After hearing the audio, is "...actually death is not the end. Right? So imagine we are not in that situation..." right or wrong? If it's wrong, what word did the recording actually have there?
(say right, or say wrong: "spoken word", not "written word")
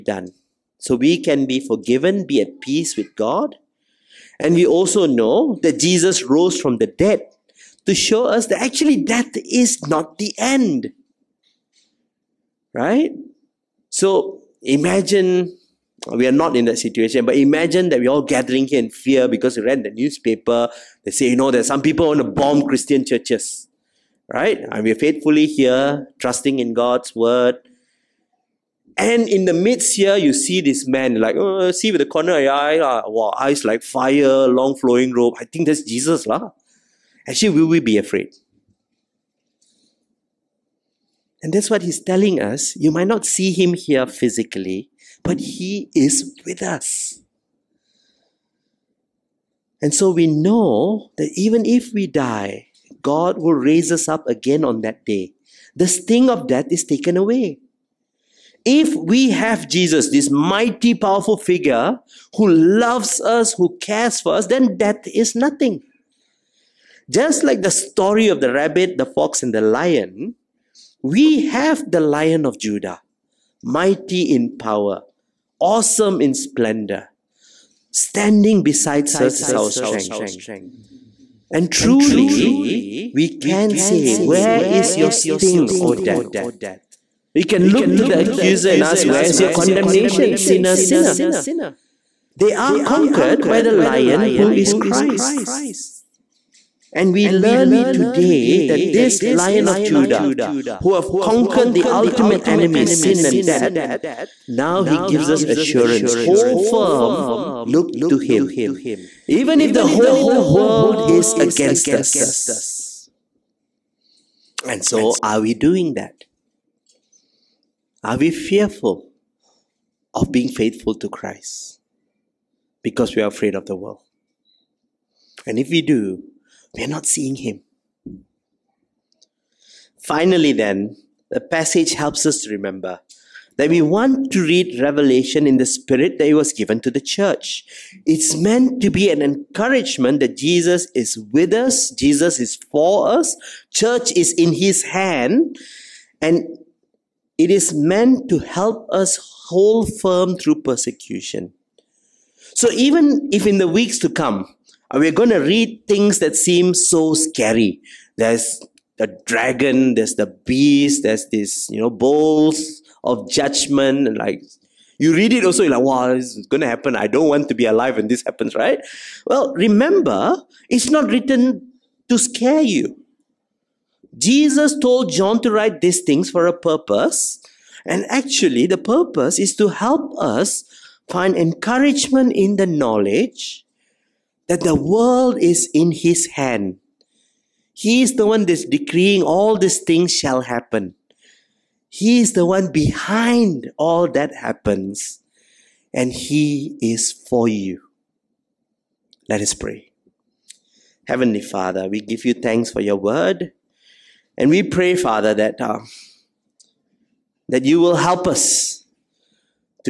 right.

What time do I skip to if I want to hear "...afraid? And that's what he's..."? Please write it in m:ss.
0:37.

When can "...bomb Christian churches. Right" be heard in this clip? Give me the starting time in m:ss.
0:22.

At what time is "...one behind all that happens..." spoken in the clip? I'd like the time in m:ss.
3:12.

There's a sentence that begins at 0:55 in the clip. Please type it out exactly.
The sting of death is taken away.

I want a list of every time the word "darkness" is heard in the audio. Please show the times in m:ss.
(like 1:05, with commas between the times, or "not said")
not said.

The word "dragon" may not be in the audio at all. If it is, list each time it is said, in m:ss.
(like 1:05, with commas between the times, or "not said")
2:39.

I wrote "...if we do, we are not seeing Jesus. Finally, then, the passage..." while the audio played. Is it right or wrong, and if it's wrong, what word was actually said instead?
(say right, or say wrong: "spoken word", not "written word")
wrong: "Him", not "Jesus".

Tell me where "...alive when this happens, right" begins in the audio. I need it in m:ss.
2:47.